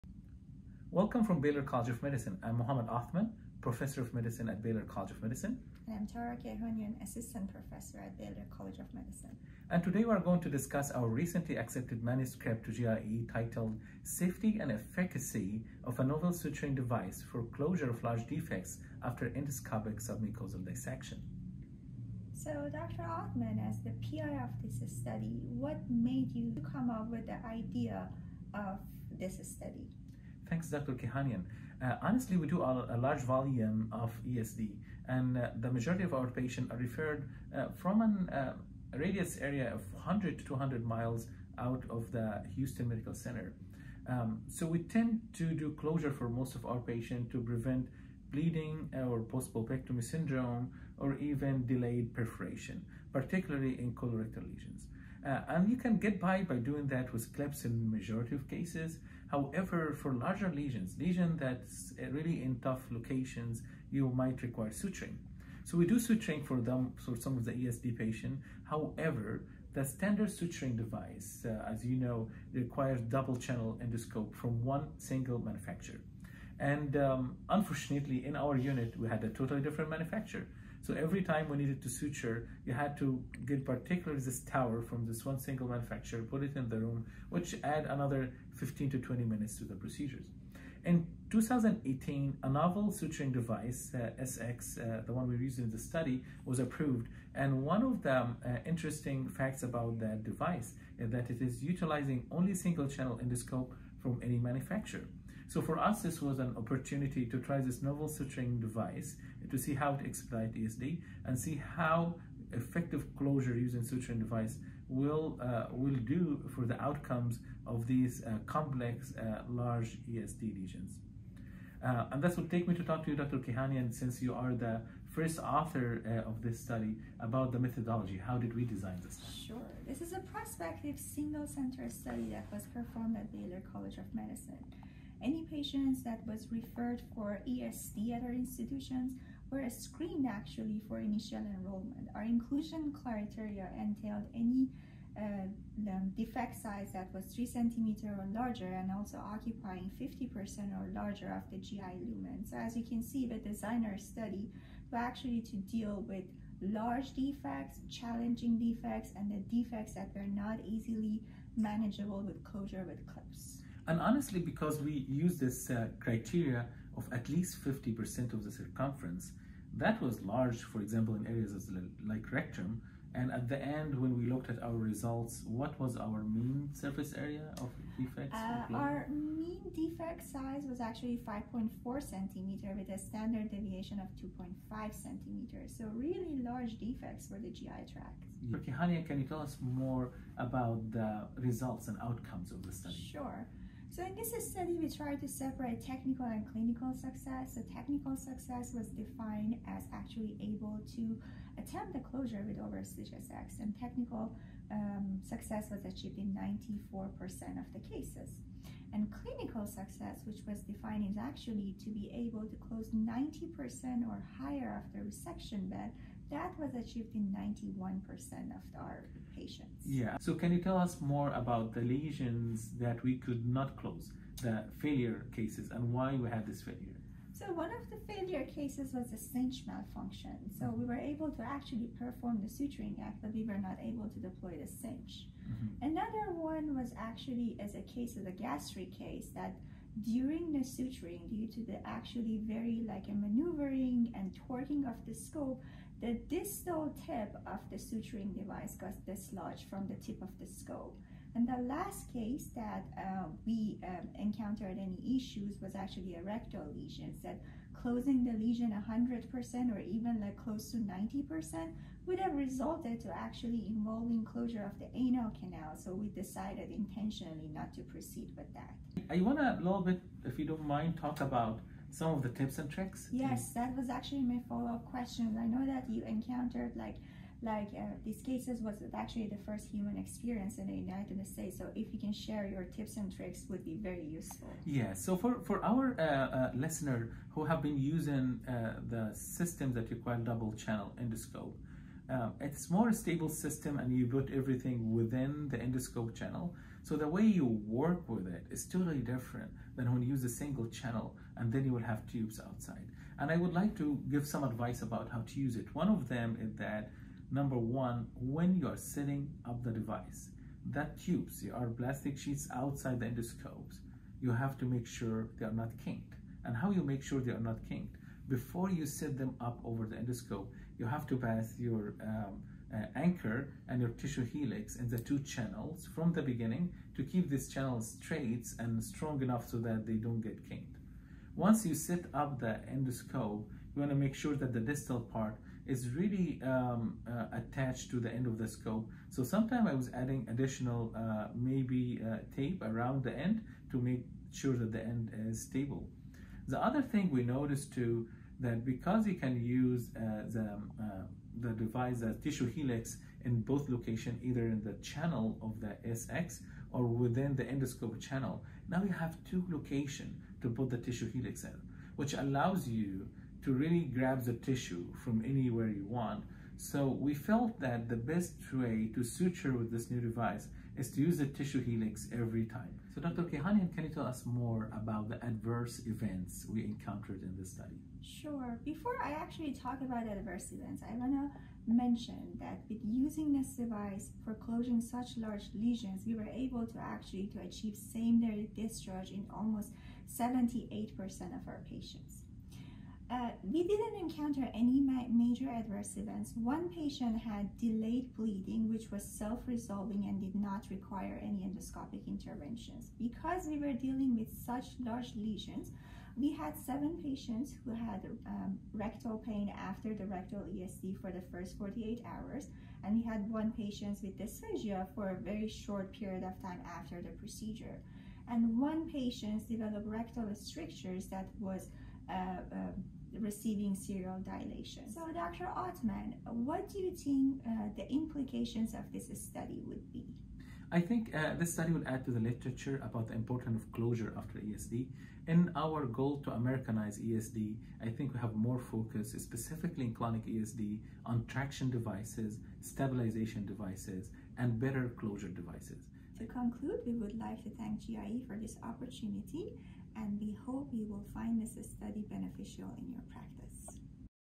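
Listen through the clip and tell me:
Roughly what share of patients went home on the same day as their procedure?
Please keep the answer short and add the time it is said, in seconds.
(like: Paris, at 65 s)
78%, at 390 s.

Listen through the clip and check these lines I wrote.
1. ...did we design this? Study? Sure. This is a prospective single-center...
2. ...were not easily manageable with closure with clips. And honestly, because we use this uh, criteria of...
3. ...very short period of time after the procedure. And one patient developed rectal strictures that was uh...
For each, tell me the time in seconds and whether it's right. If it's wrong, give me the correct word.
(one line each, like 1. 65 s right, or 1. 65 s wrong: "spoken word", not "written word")
1. 128 s right
2. 160 s right
3. 415 s right.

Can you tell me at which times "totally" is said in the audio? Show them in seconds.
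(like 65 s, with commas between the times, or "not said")
79 s, 298 s.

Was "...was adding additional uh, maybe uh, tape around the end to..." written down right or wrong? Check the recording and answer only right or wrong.
right.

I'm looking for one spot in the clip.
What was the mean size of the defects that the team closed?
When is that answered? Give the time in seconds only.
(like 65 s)
181 s.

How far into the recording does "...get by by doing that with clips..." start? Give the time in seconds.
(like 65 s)
55 s.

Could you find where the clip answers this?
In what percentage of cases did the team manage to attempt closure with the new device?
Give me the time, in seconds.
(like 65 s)
206 s.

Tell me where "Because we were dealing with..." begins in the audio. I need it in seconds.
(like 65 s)
402 s.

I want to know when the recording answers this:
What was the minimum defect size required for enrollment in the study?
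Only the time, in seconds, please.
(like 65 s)
147 s.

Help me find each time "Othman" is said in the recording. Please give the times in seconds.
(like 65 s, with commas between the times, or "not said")
2 s, 23 s, 425 s.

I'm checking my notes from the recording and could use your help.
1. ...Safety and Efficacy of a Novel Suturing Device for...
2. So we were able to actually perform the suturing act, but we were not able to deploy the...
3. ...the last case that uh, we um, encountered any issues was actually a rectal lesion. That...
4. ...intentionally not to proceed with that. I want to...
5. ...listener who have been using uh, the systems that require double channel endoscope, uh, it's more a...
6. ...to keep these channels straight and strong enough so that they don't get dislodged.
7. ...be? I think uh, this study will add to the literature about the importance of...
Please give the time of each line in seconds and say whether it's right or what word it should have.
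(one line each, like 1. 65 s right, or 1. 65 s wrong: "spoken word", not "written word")
1. 14 s right
2. 230 s right
3. 251 s right
4. 266 s right
5. 286 s right
6. 326 s wrong: "kinked", not "dislodged"
7. 429 s right.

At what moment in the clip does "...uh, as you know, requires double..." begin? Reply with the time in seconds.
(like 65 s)
71 s.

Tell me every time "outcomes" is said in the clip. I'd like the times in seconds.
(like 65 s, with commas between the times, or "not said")
116 s, 192 s.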